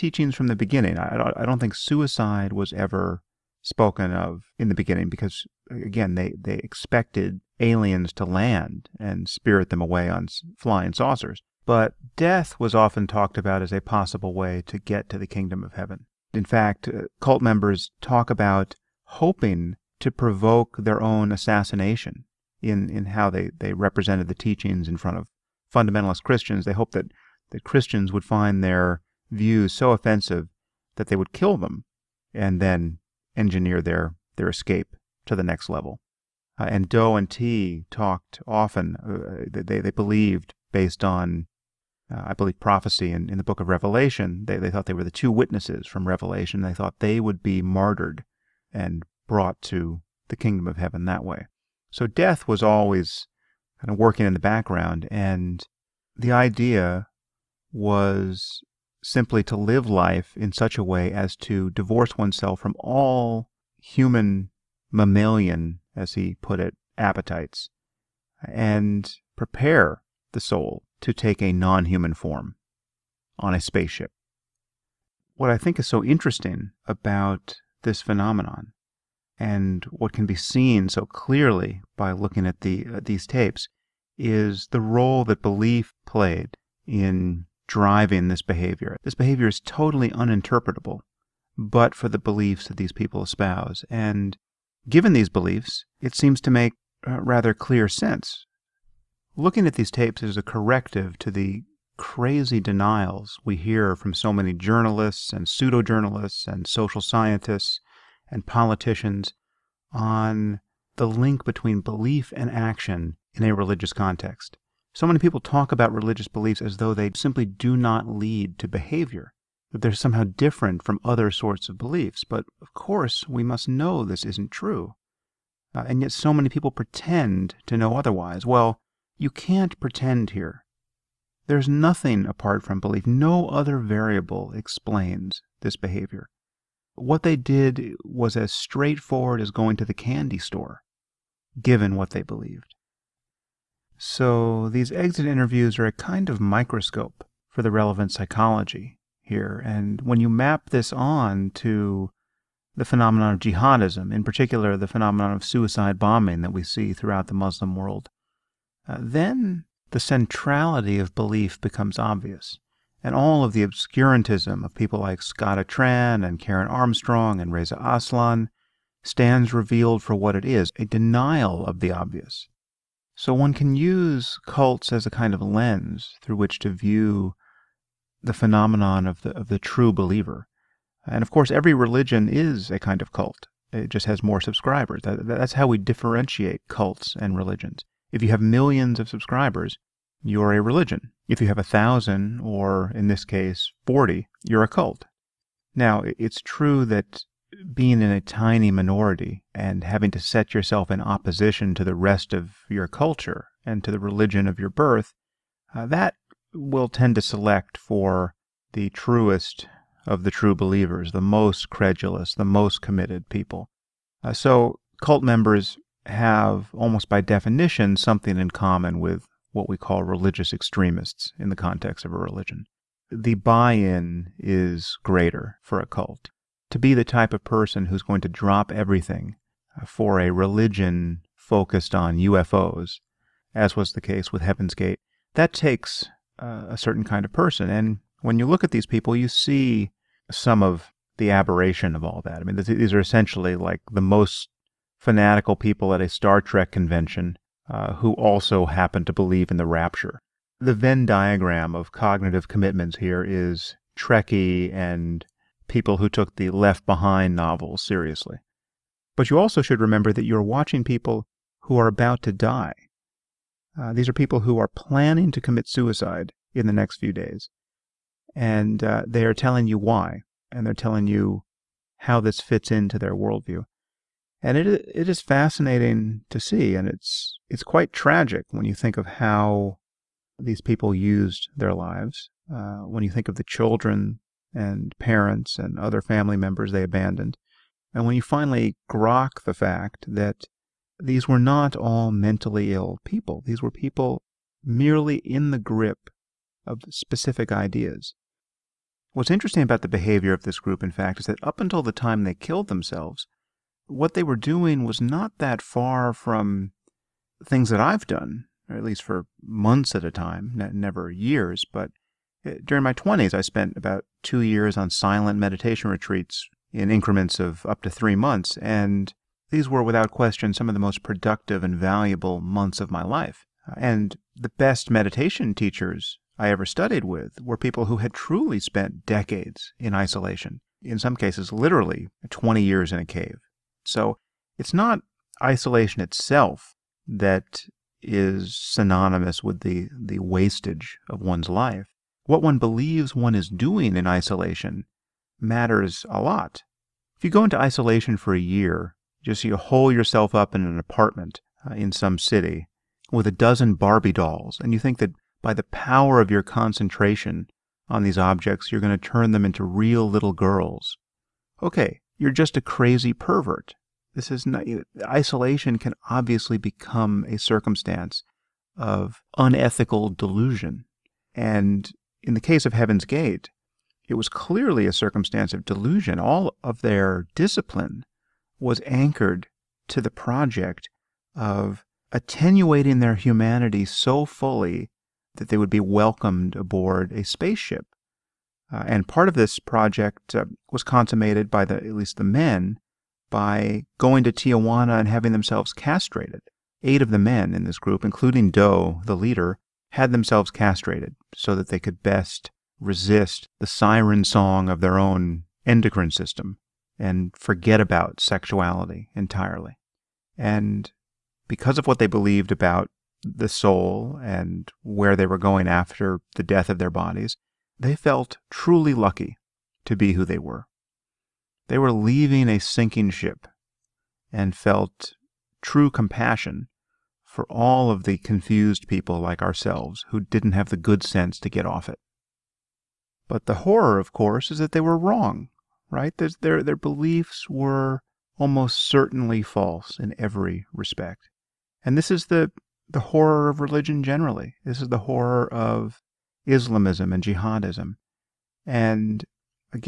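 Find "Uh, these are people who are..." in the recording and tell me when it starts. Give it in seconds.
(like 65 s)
263 s.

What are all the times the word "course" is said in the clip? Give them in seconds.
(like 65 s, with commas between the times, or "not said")
122 s, 181 s, 434 s.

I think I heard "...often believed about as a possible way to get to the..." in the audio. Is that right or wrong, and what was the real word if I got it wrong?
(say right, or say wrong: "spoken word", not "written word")
wrong: "talked", not "believed".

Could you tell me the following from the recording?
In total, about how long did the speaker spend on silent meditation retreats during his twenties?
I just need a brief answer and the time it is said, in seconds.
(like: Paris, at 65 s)
2 years, at 314 s.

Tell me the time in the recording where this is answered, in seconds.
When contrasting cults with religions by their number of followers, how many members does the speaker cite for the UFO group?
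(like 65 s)
193 s.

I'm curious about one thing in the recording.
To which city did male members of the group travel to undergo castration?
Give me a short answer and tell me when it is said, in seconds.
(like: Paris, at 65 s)
Tijuana, at 394 s.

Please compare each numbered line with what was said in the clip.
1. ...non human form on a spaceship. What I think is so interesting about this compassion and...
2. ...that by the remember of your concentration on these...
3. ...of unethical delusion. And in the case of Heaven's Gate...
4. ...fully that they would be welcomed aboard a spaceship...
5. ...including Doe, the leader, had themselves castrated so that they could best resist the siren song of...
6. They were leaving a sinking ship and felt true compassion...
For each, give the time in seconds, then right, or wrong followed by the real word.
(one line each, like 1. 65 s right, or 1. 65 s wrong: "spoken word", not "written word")
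1. 71 s wrong: "phenomenon", not "compassion"
2. 354 s wrong: "power", not "remember"
3. 368 s right
4. 384 s right
5. 398 s right
6. 421 s right.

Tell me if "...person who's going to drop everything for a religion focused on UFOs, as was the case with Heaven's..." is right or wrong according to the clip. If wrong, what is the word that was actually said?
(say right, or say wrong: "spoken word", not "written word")
right.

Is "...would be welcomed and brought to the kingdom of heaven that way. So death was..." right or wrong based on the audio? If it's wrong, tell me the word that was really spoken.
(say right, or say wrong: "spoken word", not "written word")
wrong: "martyred", not "welcomed".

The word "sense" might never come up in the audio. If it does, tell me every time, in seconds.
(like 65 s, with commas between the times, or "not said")
97 s, 431 s.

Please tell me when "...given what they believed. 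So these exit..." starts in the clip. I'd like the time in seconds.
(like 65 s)
141 s.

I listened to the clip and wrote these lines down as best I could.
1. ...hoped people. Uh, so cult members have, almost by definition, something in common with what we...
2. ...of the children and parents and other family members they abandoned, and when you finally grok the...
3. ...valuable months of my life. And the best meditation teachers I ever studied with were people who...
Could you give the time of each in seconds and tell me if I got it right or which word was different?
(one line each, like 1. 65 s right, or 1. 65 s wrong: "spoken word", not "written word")
1. 212 s wrong: "committed", not "hoped"
2. 283 s right
3. 321 s right.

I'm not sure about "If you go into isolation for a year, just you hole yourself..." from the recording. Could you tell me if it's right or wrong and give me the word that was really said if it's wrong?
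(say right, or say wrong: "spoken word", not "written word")
right.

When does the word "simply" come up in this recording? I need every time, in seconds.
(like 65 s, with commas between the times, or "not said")
59 s, 117 s.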